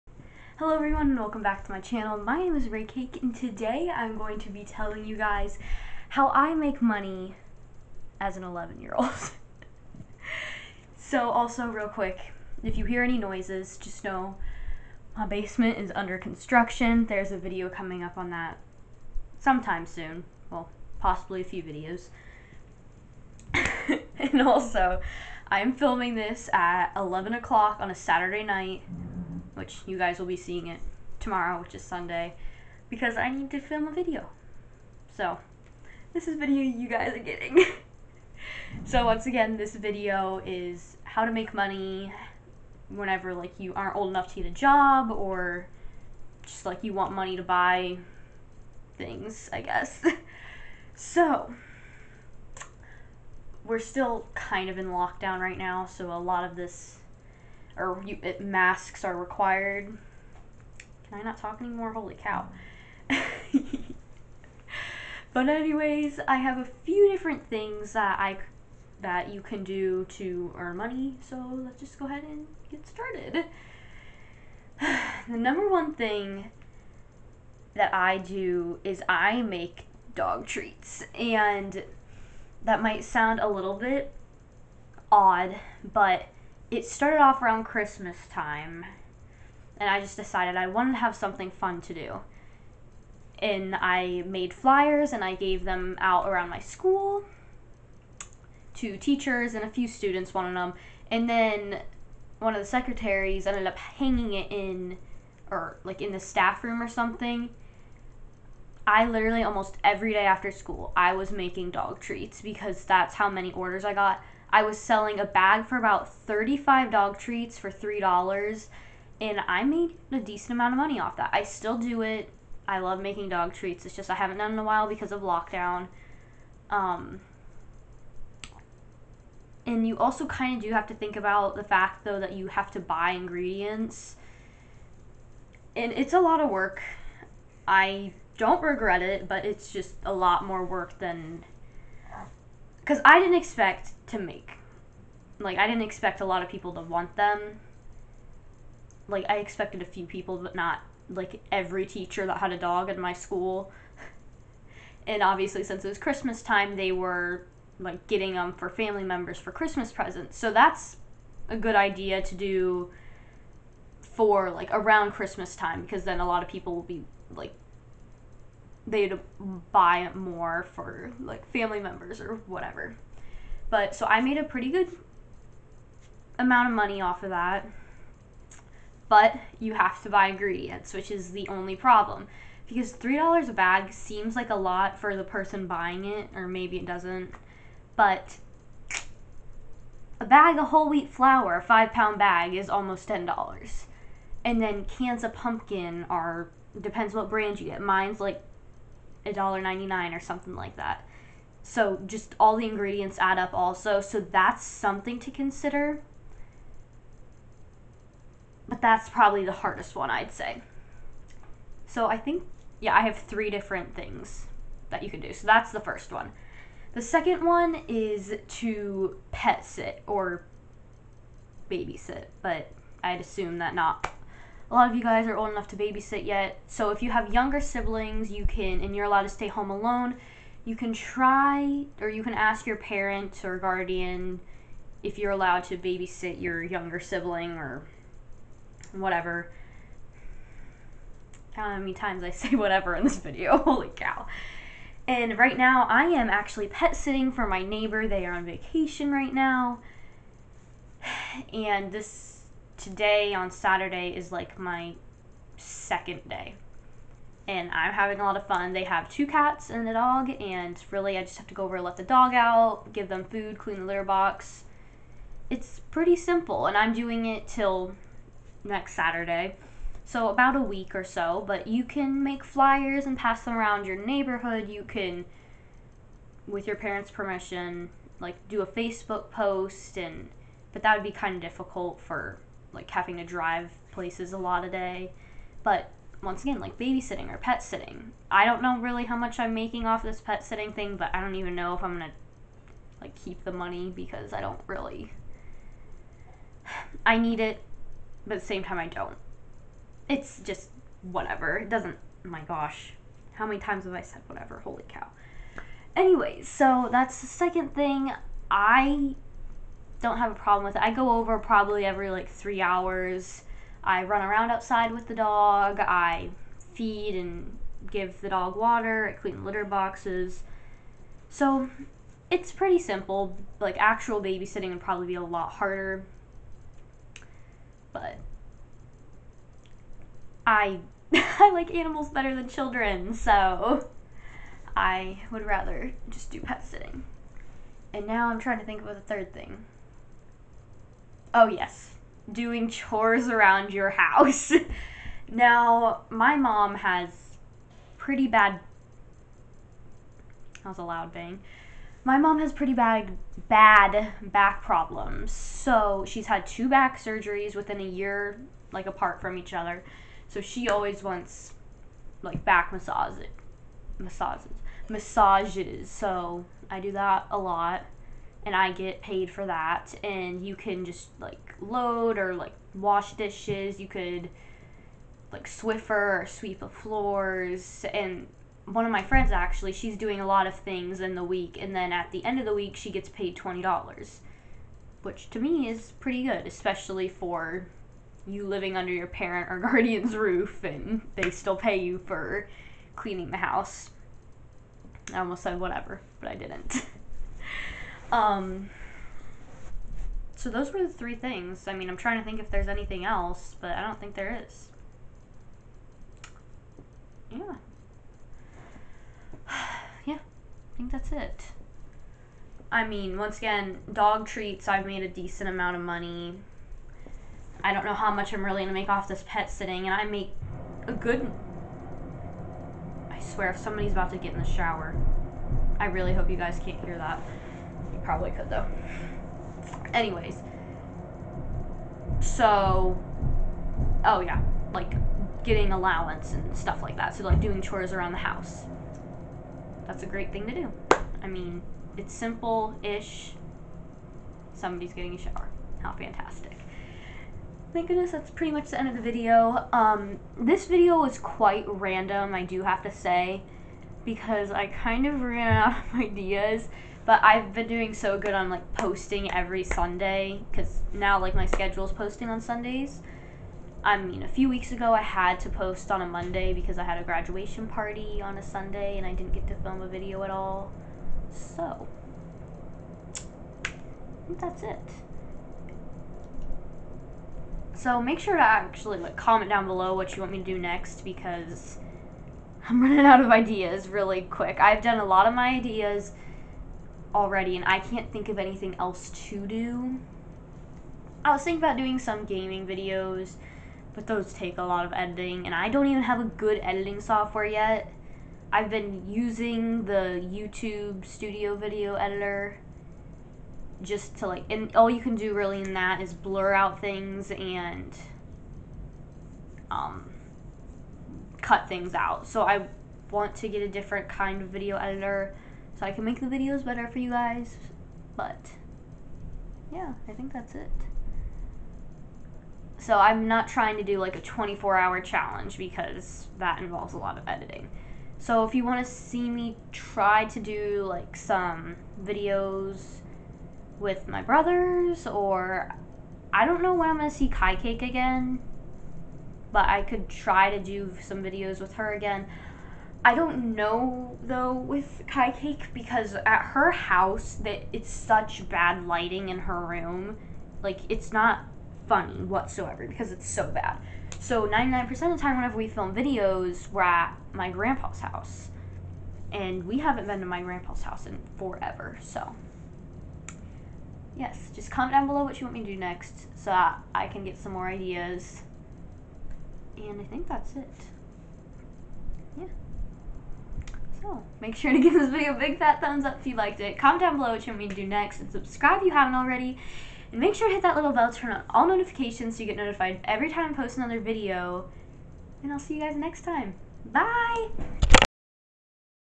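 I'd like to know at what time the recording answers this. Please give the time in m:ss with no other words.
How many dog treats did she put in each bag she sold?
1:56.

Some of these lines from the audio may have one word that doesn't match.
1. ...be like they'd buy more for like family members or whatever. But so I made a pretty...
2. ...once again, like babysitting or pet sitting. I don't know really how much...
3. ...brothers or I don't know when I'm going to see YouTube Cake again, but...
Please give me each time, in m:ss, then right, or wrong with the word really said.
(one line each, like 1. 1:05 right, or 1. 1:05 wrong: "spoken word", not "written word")
1. 2:46 right
2. 4:46 right
3. 8:54 wrong: "Kai", not "YouTube".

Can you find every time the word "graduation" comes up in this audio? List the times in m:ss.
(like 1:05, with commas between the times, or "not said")
7:47.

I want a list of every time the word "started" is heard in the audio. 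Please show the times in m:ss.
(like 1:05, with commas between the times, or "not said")
1:12, 1:26.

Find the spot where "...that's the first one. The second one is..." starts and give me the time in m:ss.
3:35.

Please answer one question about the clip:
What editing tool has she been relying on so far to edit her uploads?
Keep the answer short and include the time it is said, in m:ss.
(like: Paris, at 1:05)
YouTube Studio Video Editor, at 8:20.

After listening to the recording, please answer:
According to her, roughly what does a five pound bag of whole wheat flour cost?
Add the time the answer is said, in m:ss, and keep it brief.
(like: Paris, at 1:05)
almost $10, at 3:12.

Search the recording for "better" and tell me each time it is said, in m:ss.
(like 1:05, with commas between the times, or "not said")
5:32, 8:36.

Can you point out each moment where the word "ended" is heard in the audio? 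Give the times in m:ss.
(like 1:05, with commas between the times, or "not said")
1:43.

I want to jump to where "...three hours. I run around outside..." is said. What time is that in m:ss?
5:12.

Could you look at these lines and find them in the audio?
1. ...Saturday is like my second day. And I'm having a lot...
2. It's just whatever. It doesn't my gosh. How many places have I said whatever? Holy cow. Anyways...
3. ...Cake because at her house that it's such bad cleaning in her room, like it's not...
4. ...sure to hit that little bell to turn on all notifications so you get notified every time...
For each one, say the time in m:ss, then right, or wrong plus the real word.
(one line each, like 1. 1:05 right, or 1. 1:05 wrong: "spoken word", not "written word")
1. 4:13 right
2. 5:00 wrong: "times", not "places"
3. 9:05 wrong: "lighting", not "cleaning"
4. 9:40 right.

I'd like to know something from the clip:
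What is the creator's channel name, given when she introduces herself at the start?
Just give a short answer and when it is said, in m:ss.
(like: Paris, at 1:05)
Ray Cake, at 0:02.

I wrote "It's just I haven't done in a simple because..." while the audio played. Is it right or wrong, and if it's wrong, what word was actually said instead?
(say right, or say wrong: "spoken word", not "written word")
wrong: "while", not "simple".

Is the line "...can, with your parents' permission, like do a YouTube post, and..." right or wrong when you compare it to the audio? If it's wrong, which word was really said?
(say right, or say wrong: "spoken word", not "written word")
wrong: "Facebook", not "YouTube".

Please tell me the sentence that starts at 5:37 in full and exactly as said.
And now I'm trying to think of the third thing.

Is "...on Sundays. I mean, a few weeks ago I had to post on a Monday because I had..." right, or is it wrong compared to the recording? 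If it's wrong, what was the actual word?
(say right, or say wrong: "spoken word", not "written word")
right.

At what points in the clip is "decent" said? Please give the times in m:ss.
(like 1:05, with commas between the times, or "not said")
2:00, 6:55.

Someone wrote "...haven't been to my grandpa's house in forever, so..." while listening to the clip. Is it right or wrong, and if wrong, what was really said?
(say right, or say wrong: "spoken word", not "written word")
right.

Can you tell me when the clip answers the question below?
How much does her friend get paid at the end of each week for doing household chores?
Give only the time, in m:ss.
6:23.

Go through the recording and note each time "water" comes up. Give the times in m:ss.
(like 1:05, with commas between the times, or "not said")
5:18.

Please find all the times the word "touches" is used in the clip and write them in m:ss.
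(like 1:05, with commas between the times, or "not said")
not said.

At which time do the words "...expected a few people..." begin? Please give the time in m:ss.
2:29.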